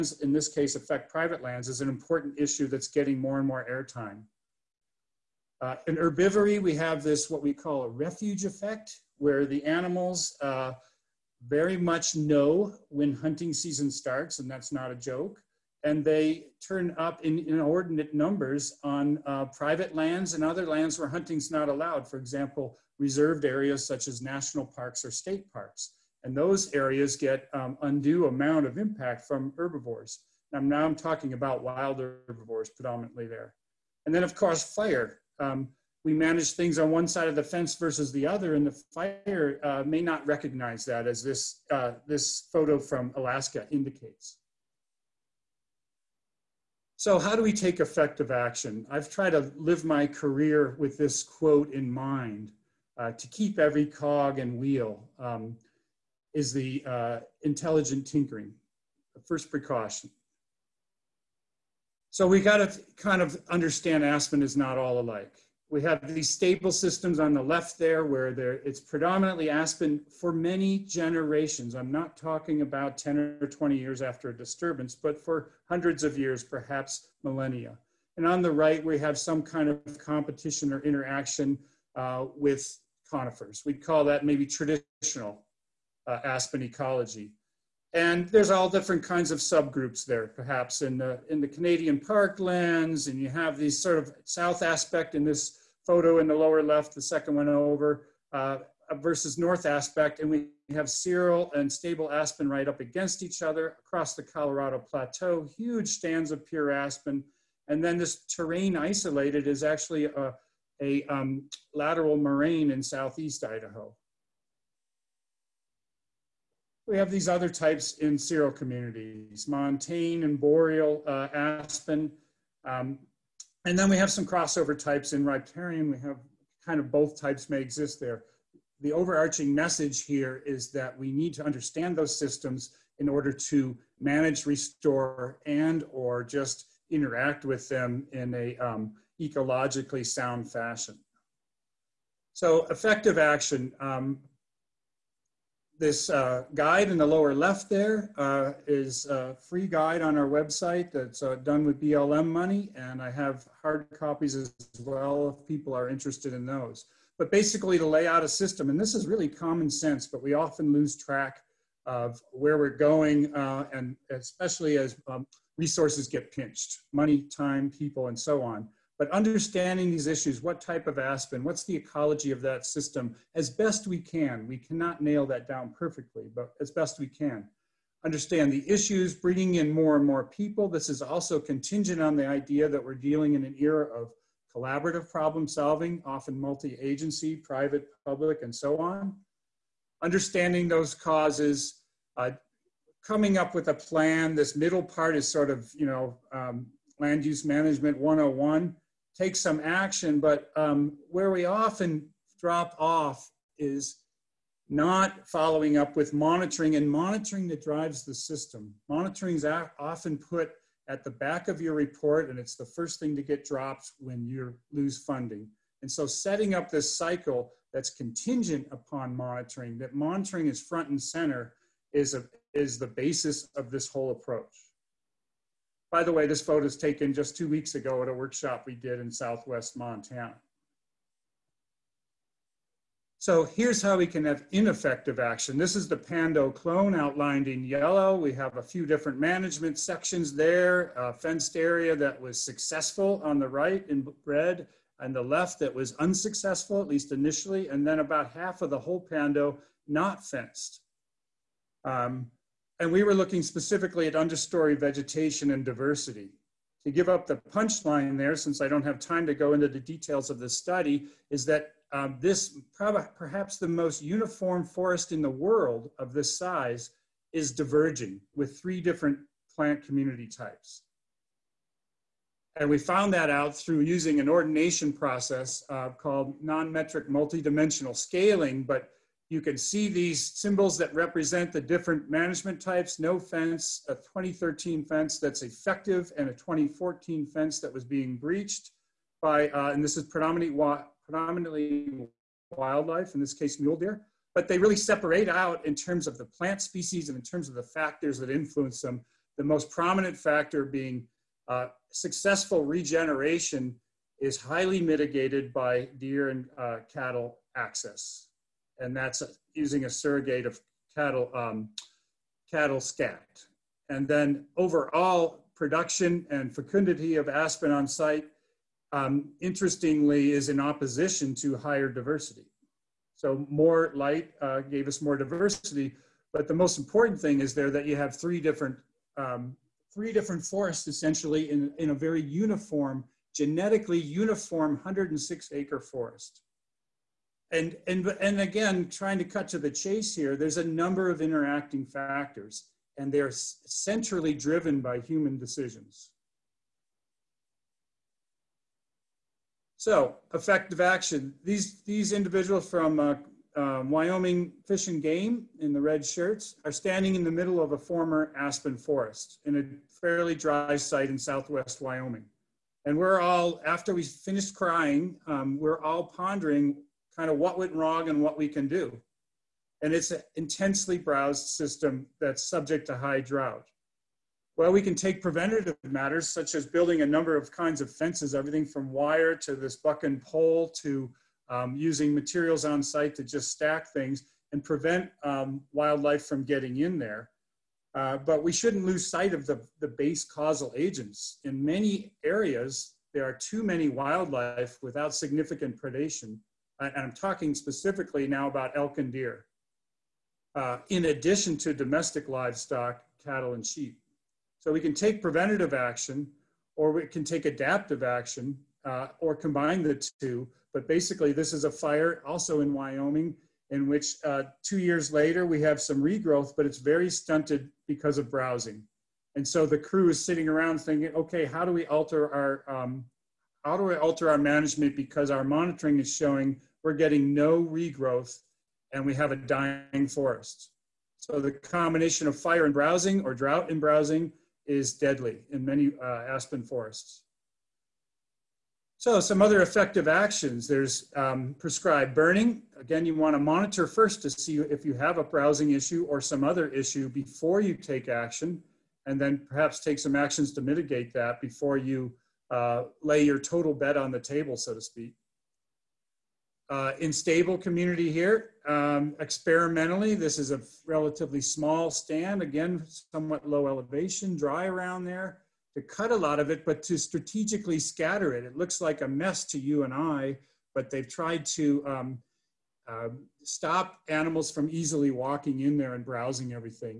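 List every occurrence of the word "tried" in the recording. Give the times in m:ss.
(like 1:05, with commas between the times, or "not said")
0:49, 7:51.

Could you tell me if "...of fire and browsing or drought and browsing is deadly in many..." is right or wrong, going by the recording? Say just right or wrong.
right.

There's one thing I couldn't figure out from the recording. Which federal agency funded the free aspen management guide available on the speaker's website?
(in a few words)
BLM.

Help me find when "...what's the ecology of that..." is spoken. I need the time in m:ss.
2:51.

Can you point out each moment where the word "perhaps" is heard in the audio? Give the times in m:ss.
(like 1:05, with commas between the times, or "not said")
1:16, 1:30, 4:23, 7:29.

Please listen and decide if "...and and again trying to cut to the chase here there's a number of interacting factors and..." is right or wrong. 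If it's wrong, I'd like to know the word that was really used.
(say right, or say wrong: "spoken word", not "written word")
right.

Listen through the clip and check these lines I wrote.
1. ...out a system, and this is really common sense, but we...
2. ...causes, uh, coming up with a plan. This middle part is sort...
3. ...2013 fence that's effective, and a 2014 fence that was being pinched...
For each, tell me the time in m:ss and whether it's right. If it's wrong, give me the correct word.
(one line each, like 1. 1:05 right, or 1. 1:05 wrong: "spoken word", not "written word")
1. 2:38 right
2. 3:10 right
3. 4:43 wrong: "breached", not "pinched".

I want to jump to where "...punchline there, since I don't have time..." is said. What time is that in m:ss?
4:17.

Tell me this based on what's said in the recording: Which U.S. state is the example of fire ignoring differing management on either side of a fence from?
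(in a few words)
Alaska.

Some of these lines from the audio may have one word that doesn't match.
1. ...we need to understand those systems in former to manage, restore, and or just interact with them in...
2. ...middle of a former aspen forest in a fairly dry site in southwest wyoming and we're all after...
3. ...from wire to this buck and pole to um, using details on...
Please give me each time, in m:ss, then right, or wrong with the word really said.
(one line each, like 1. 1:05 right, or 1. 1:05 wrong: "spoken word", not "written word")
1. 2:10 wrong: "order", not "former"
2. 5:57 right
3. 6:18 wrong: "materials", not "details".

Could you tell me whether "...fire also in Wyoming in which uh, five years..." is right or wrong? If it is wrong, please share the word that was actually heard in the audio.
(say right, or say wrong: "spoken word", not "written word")
wrong: "two", not "five".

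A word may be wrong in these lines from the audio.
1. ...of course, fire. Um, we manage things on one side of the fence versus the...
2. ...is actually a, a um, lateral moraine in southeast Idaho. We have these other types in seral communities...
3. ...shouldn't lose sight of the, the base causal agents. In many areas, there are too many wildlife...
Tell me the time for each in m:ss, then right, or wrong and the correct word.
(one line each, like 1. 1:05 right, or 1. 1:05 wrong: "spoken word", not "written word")
1. 0:34 right
2. 1:49 right
3. 6:28 right.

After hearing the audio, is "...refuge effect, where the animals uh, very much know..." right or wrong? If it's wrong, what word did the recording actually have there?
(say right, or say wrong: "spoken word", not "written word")
right.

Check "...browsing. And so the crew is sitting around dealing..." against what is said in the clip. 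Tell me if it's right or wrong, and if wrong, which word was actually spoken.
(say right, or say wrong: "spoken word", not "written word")
wrong: "thinking", not "dealing".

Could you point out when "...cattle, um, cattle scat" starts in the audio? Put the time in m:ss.
5:10.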